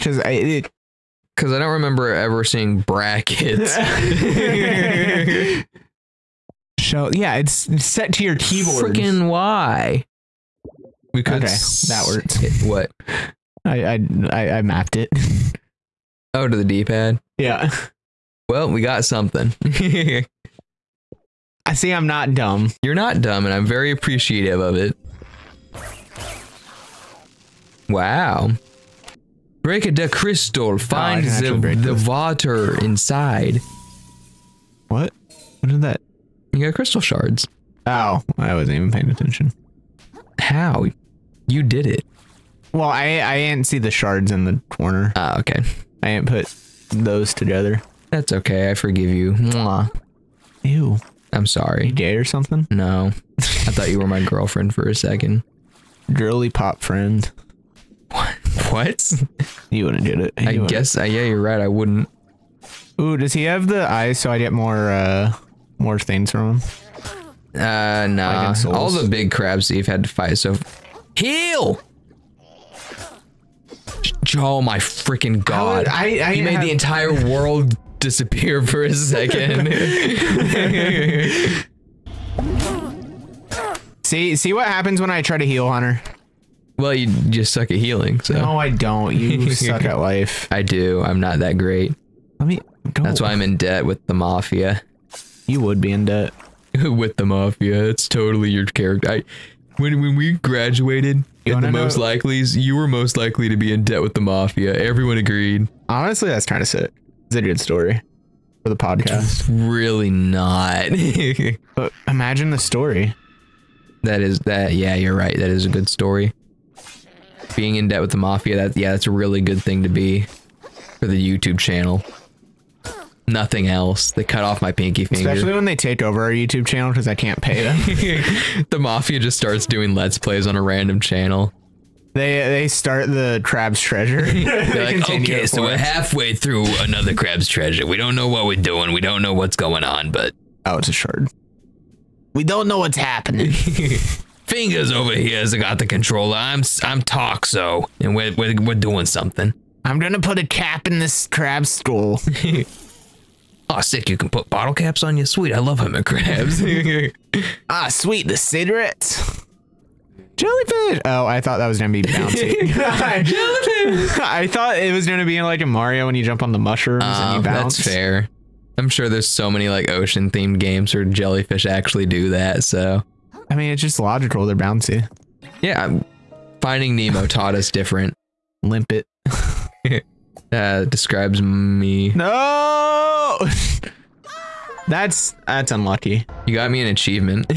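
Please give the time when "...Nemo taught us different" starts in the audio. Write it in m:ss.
2:56.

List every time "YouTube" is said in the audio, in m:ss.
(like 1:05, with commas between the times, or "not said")
2:01, 2:06.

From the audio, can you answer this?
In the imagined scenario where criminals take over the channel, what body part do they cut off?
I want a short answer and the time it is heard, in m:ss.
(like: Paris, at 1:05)
Pinky finger, at 2:04.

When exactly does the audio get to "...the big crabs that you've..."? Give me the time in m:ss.
1:08.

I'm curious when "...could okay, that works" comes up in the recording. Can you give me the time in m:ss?
0:11.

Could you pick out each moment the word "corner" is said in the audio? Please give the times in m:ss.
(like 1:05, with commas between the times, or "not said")
0:44.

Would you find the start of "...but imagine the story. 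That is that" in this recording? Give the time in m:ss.
1:51.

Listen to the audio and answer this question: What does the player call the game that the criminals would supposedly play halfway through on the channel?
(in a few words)
Another Crab's Treasure.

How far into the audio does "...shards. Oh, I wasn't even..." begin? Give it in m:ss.
0:37.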